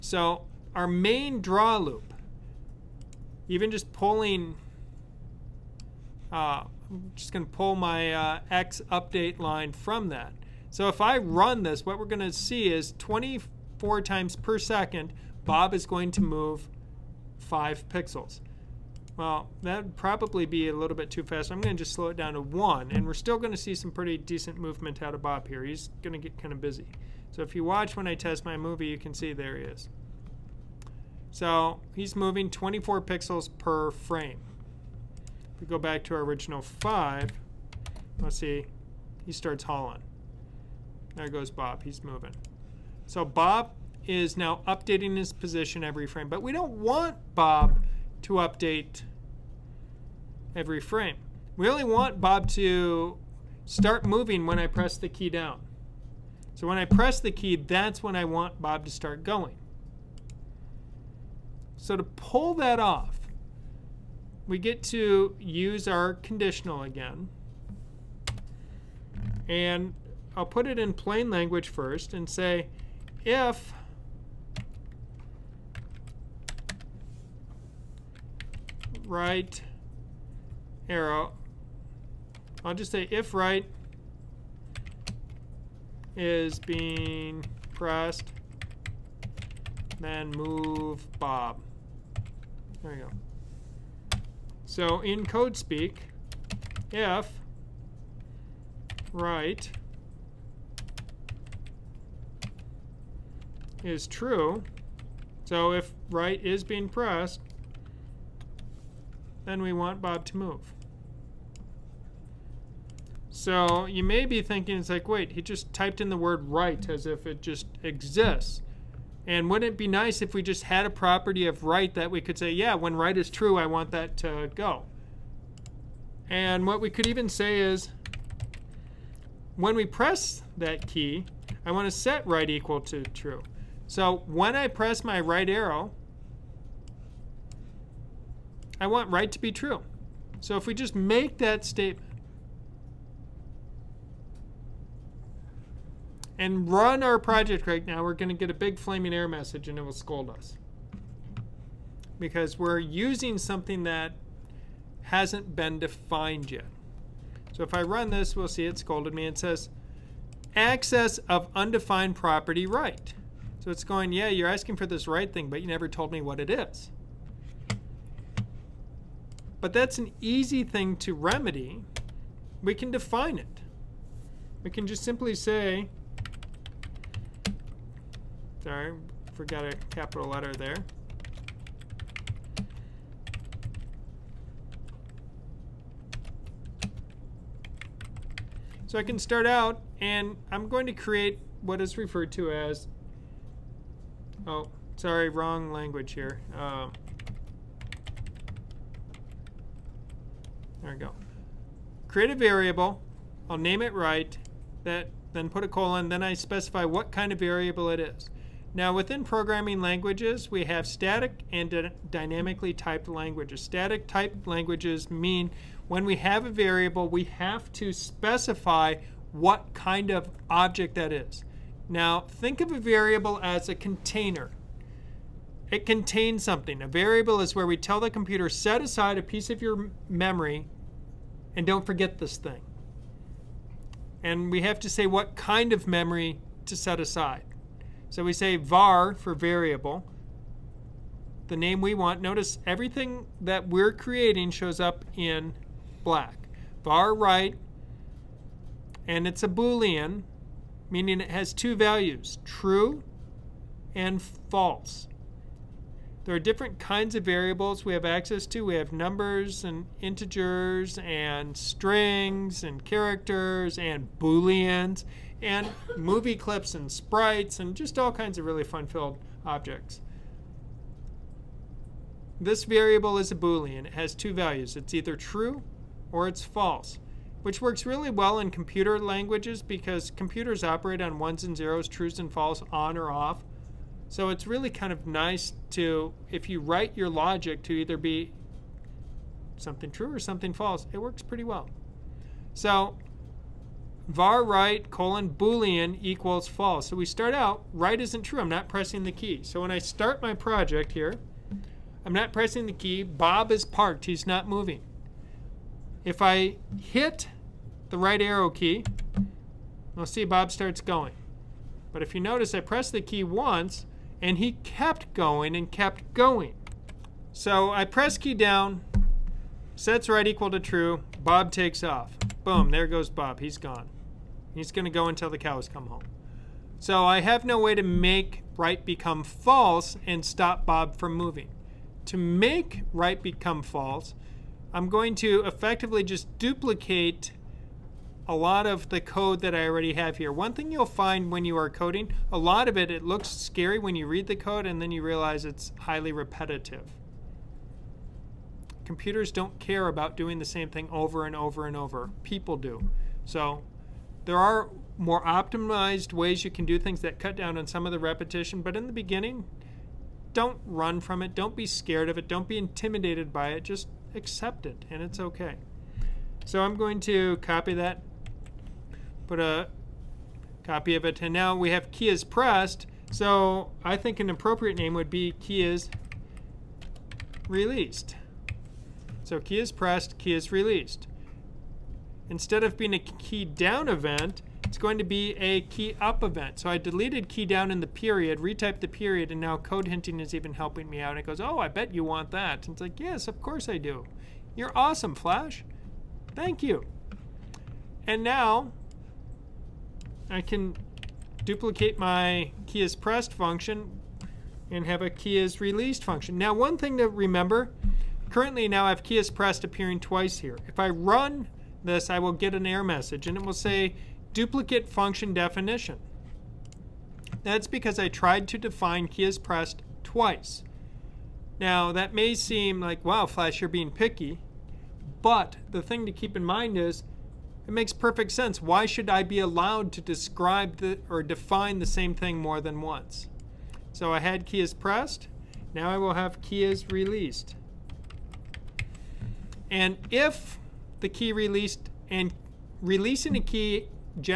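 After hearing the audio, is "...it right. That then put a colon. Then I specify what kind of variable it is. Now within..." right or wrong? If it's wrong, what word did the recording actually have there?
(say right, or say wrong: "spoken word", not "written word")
right.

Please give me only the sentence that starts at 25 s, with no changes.
He's going to get kind of busy.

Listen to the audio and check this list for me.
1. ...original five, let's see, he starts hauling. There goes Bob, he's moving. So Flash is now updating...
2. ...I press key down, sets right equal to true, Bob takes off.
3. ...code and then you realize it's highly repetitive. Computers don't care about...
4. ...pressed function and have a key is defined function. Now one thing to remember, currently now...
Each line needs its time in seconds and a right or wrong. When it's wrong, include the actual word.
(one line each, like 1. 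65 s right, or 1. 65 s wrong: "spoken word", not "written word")
1. 36 s wrong: "Bob", not "Flash"
2. 317 s right
3. 344 s right
4. 402 s wrong: "released", not "defined".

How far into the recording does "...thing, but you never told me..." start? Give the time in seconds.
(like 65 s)
165 s.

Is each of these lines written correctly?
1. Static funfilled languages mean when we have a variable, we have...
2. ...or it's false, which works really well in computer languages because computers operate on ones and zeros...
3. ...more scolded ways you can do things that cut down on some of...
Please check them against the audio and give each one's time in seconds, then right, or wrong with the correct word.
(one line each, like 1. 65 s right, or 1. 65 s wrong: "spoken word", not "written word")
1. 213 s wrong: "typed", not "funfilled"
2. 276 s right
3. 354 s wrong: "optimized", not "scolded".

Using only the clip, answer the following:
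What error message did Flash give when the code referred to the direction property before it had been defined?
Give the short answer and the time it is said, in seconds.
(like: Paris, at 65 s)
access of undefined property right, at 160 s.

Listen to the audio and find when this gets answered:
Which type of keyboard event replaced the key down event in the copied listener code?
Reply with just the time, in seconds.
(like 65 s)
385 s.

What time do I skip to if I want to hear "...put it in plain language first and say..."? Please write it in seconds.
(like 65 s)
70 s.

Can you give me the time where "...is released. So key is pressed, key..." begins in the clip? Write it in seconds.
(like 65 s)
375 s.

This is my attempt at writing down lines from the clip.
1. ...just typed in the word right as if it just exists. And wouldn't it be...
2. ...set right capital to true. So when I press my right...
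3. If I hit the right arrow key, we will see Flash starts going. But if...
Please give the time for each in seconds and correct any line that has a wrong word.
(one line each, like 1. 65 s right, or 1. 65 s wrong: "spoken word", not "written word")
1. 115 s right
2. 131 s wrong: "equal", not "capital"
3. 306 s wrong: "Bob", not "Flash".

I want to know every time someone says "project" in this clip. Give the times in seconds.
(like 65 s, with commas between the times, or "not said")
147 s, 300 s.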